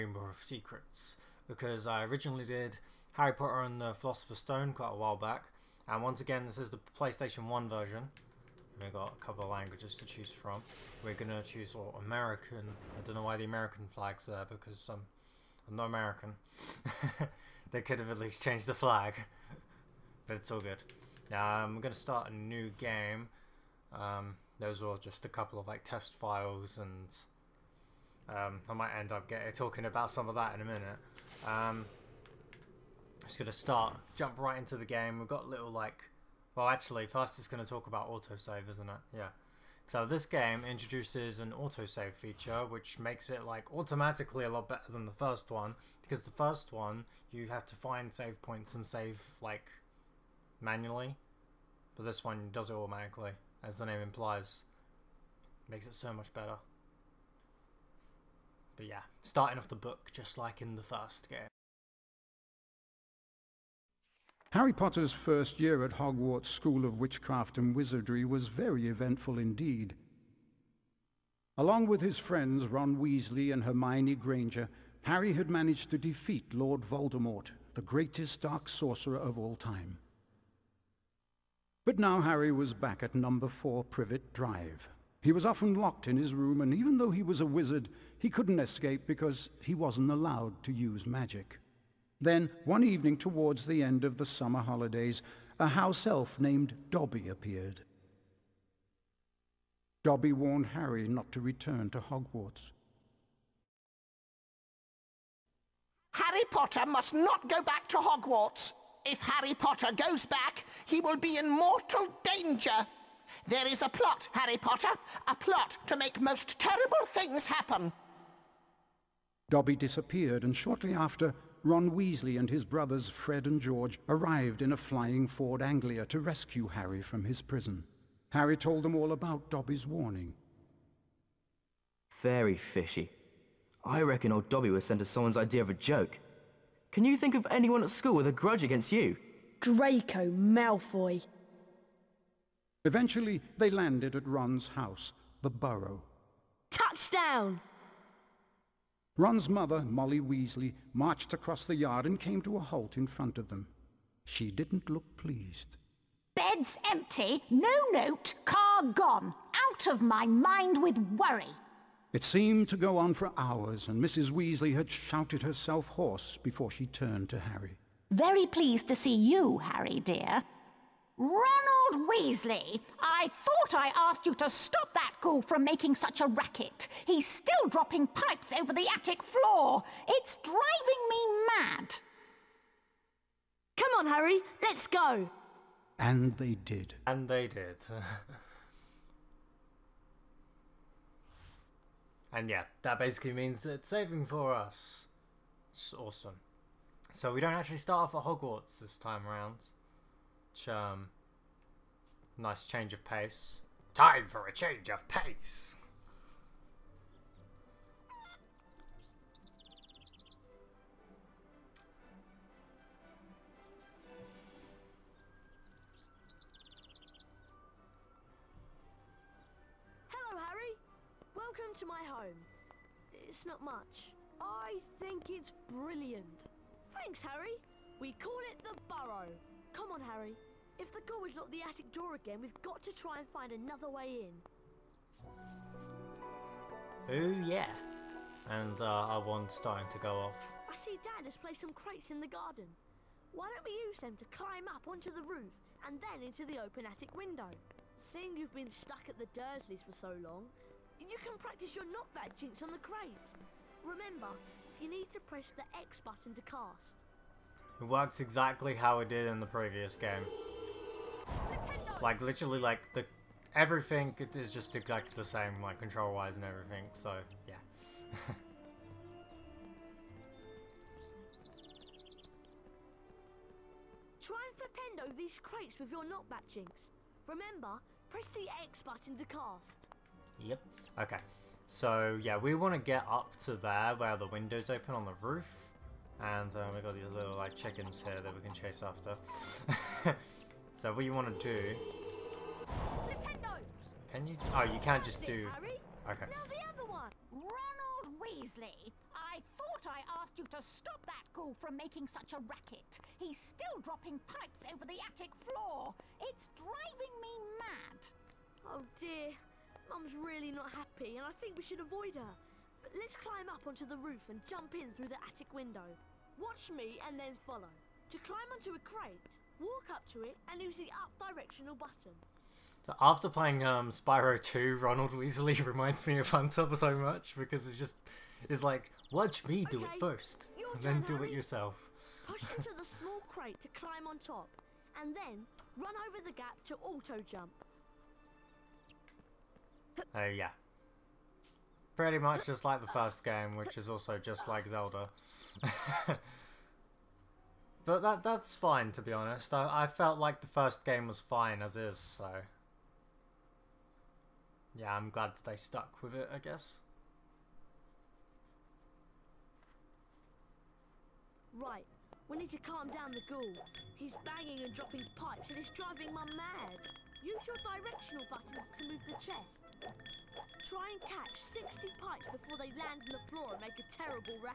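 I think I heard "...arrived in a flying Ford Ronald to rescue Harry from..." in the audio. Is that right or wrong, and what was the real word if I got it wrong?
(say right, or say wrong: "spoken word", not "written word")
wrong: "Anglia", not "Ronald".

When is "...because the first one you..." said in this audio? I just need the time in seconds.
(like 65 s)
46 s.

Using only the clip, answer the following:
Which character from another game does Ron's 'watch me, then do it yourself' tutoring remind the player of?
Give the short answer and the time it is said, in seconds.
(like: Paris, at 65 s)
Hunter, at 326 s.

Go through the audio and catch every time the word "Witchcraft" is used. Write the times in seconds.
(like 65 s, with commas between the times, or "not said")
66 s.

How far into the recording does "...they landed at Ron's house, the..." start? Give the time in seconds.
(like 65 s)
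143 s.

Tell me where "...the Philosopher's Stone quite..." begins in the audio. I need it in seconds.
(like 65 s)
3 s.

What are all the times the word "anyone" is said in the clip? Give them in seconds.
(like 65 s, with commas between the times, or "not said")
137 s.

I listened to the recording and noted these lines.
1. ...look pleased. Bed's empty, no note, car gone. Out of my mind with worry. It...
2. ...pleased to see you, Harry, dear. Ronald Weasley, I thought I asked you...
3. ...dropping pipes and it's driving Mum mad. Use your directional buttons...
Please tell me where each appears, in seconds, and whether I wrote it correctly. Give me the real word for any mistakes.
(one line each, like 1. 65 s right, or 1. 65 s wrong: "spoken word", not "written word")
1. 154 s right
2. 168 s right
3. 364 s right.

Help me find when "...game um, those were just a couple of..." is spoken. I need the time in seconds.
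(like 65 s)
22 s.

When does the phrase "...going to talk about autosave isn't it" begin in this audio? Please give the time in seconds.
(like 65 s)
37 s.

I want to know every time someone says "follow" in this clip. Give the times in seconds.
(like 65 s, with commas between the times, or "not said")
317 s.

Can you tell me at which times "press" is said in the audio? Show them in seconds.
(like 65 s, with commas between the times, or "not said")
255 s, 278 s.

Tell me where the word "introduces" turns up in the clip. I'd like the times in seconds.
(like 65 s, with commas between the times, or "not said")
40 s.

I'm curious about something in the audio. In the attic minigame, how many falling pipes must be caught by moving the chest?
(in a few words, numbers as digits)
60.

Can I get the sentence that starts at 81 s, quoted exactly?
But now Harry was back at number 4 Privet Drive.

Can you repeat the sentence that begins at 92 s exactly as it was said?
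Then, one evening towards the end of the summer holidays, a house elf named Dobby appeared.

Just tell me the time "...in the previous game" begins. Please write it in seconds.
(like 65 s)
259 s.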